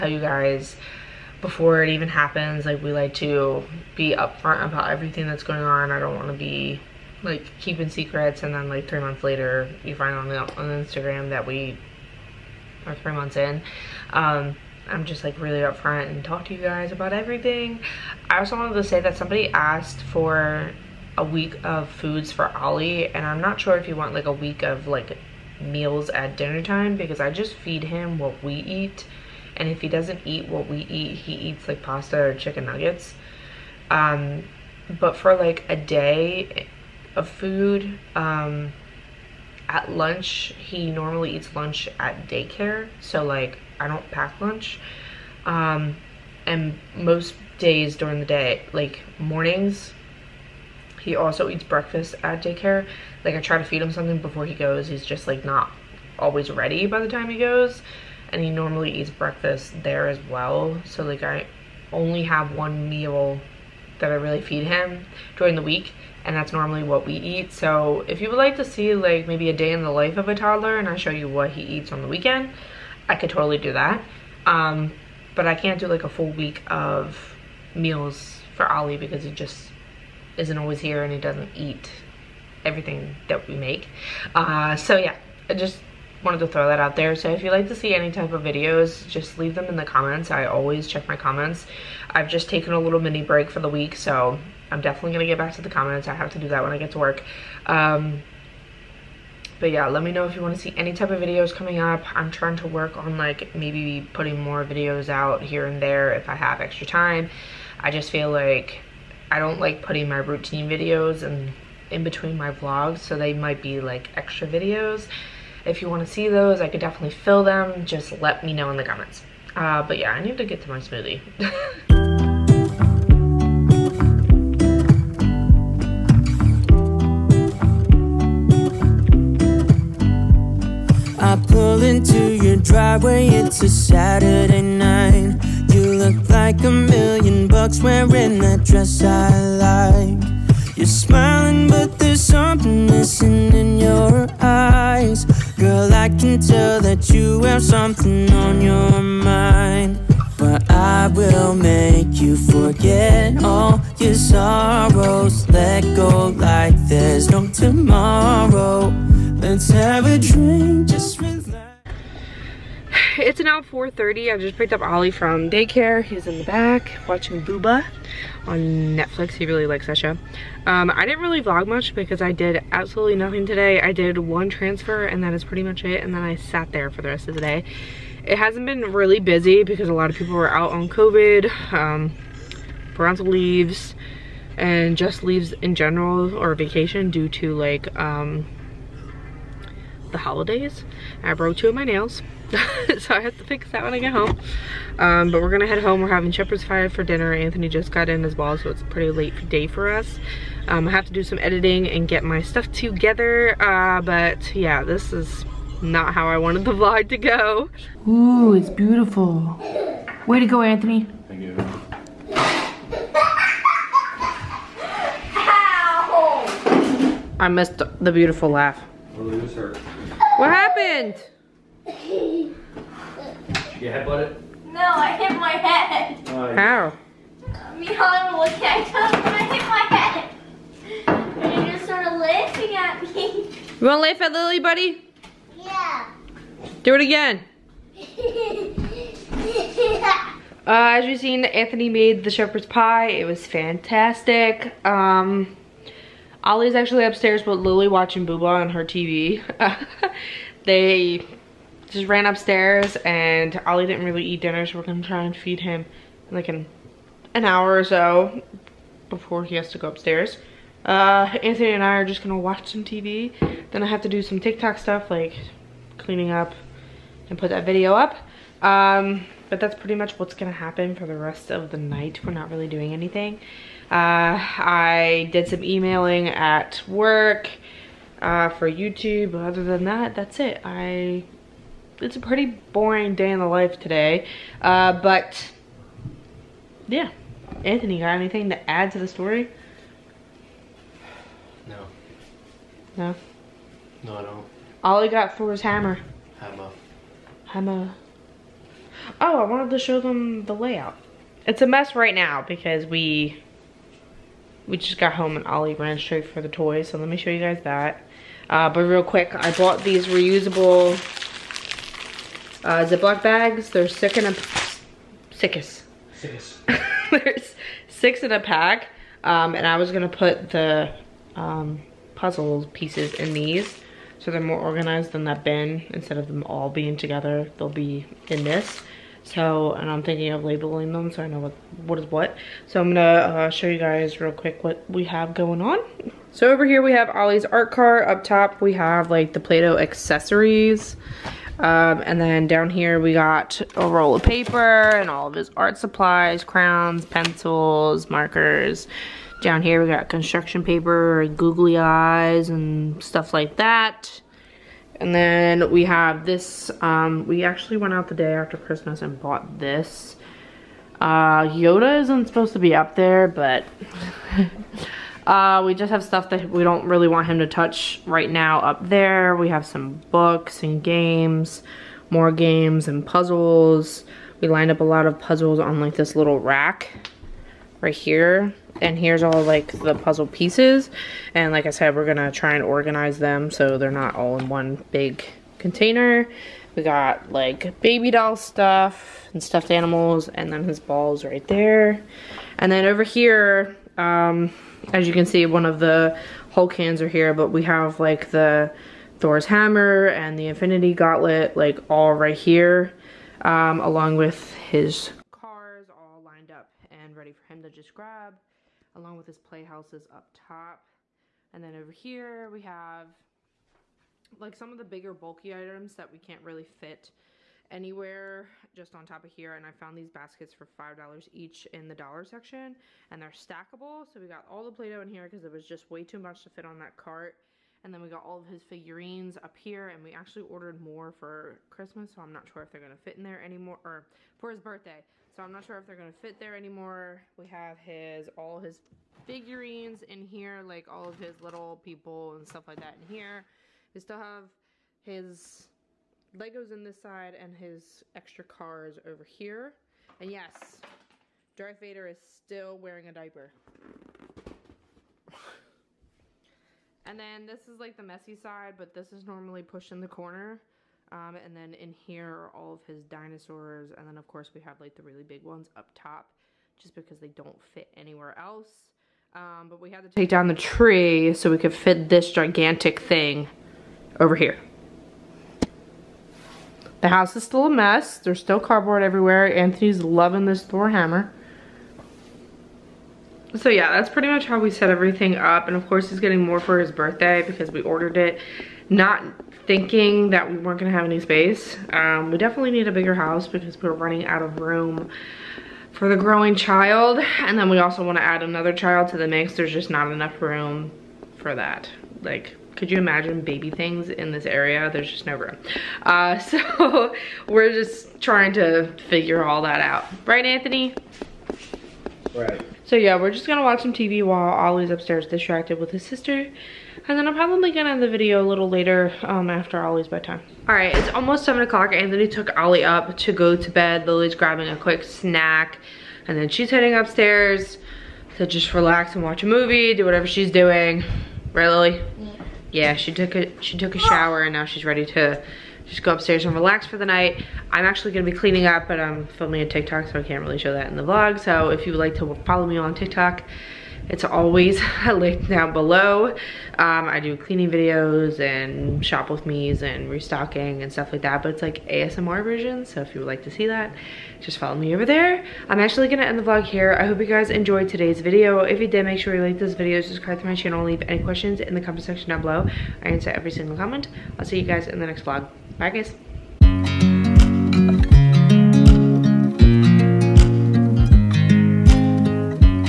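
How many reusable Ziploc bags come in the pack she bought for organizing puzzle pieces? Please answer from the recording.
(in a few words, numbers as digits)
6.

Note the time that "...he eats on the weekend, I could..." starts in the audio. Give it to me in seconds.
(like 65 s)
71 s.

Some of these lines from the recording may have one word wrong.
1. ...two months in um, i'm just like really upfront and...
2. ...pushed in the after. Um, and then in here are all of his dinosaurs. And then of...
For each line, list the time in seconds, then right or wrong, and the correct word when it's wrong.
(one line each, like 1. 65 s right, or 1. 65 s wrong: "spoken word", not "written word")
1. 12 s wrong: "three", not "two"
2. 459 s wrong: "corner", not "after".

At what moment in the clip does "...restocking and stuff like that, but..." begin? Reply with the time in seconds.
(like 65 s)
550 s.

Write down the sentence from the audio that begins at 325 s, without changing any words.
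Instead of them all being together, they'll be in this.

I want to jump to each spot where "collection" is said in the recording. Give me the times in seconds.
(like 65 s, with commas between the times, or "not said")
not said.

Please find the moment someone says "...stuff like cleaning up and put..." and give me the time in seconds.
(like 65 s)
264 s.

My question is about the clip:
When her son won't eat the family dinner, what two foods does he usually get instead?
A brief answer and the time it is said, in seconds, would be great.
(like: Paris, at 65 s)
Pasta or chicken nuggets, at 31 s.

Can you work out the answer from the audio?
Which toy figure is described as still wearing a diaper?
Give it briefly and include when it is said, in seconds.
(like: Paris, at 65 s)
Darth Vader, at 451 s.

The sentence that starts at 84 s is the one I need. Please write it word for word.
Uh, so yeah, just wanted to throw that out there.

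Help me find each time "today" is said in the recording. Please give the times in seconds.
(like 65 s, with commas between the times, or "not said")
173 s, 283 s, 557 s.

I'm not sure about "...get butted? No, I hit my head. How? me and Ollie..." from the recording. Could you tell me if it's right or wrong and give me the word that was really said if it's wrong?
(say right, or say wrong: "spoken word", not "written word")
right.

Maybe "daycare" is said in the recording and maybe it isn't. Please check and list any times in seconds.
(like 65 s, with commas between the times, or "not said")
42 s, 52 s, 165 s.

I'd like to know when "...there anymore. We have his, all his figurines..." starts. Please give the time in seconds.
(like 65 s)
436 s.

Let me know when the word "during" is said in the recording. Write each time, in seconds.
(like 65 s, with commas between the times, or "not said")
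47 s, 65 s.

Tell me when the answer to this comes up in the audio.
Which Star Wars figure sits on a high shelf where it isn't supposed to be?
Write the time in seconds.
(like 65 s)
361 s.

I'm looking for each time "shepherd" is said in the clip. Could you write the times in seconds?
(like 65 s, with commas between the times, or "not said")
196 s, 242 s.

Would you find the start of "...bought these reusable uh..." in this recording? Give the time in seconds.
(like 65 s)
309 s.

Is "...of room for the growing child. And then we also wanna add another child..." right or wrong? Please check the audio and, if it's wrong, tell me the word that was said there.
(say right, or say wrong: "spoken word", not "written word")
right.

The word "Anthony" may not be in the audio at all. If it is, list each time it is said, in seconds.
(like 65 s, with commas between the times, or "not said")
197 s, 210 s, 241 s, 261 s, 287 s, 479 s, 510 s, 521 s.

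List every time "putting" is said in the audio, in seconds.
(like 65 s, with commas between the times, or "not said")
104 s, 109 s.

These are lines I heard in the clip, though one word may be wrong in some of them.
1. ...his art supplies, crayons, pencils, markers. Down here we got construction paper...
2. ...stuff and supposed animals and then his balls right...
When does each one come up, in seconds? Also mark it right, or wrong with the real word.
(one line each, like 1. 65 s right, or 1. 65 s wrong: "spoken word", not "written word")
1. 345 s right
2. 388 s wrong: "stuffed", not "supposed".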